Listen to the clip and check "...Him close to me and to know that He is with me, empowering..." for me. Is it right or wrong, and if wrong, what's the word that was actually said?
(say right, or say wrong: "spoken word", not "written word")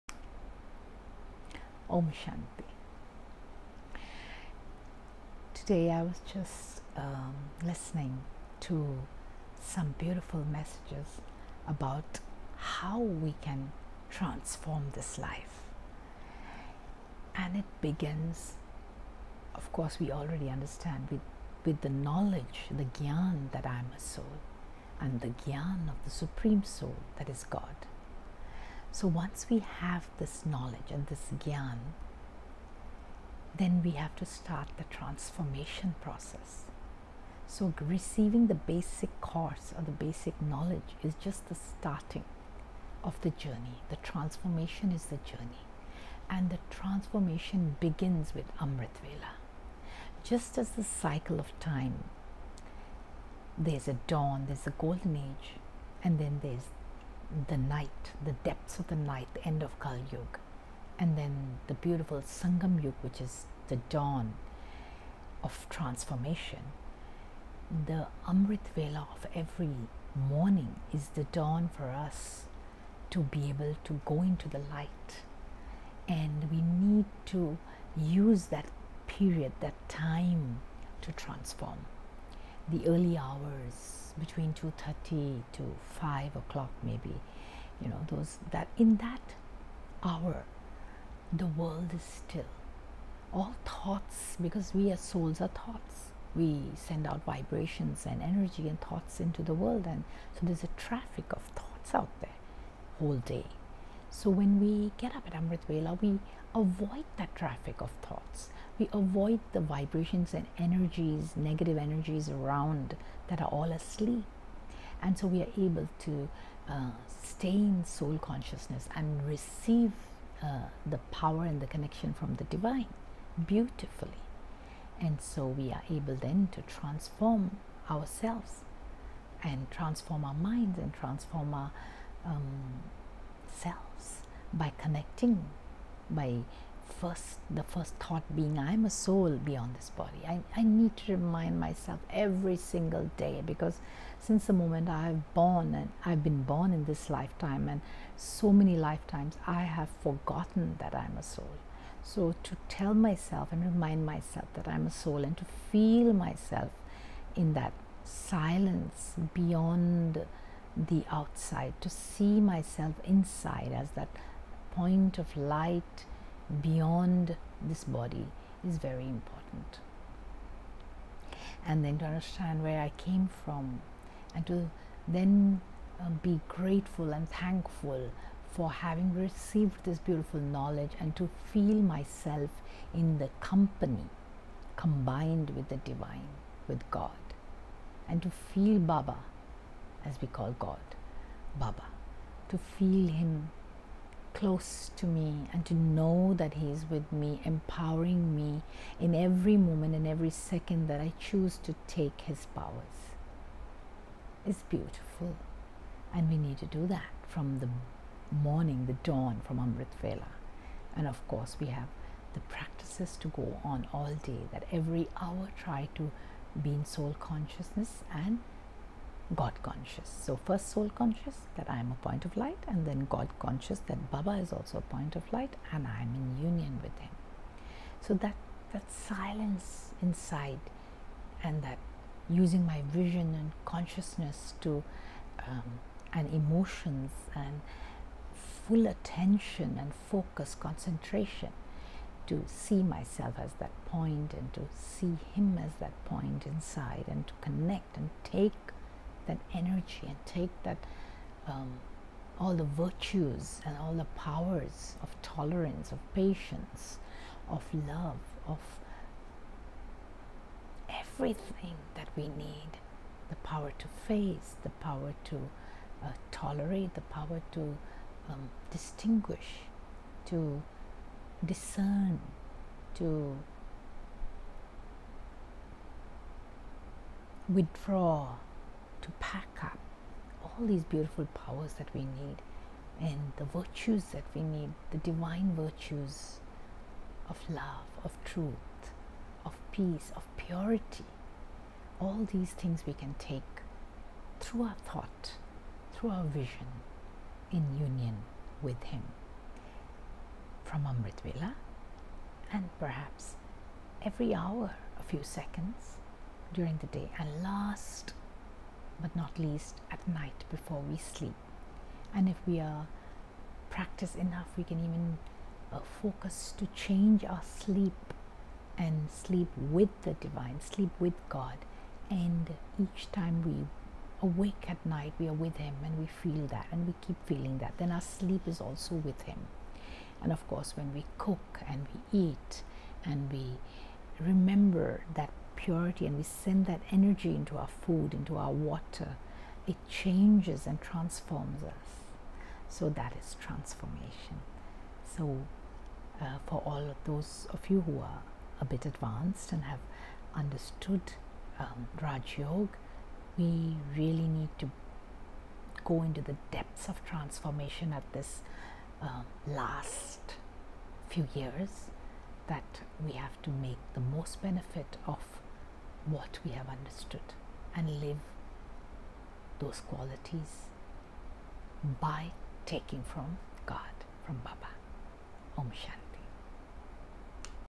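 right.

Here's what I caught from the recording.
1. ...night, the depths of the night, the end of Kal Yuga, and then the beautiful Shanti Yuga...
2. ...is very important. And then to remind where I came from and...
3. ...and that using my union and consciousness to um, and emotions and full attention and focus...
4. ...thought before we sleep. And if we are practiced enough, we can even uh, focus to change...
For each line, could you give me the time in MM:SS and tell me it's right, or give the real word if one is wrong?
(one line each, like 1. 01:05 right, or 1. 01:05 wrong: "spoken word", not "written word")
1. 00:57 wrong: "Sangam", not "Shanti"
2. 02:48 wrong: "understand", not "remind"
3. 03:51 wrong: "vision", not "union"
4. 05:10 wrong: "night", not "thought".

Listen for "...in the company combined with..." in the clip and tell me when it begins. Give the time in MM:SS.
03:02.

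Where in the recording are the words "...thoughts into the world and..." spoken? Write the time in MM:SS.
01:38.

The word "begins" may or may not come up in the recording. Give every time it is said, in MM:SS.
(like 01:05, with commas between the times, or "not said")
00:17, 00:47.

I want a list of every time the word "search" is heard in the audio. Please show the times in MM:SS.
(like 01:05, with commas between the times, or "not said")
not said.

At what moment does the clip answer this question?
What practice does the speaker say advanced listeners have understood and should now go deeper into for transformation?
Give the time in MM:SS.
05:52.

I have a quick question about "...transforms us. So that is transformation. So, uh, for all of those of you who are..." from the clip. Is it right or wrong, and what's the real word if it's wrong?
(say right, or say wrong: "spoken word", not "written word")
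right.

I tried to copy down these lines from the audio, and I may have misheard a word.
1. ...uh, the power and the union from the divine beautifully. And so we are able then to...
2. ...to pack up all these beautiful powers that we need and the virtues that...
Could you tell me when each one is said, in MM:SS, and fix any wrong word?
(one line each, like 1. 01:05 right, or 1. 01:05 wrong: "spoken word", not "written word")
1. 02:00 wrong: "connection", not "union"
2. 04:39 right.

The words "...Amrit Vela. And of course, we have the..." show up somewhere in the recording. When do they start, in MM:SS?
03:29.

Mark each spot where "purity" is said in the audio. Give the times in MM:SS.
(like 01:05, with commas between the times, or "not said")
04:50, 05:35.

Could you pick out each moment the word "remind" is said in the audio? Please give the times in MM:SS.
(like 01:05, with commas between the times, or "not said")
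02:21, 02:33.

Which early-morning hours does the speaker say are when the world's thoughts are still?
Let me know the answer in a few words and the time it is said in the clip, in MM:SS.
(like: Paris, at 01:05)
2:30 to 5, at 01:24.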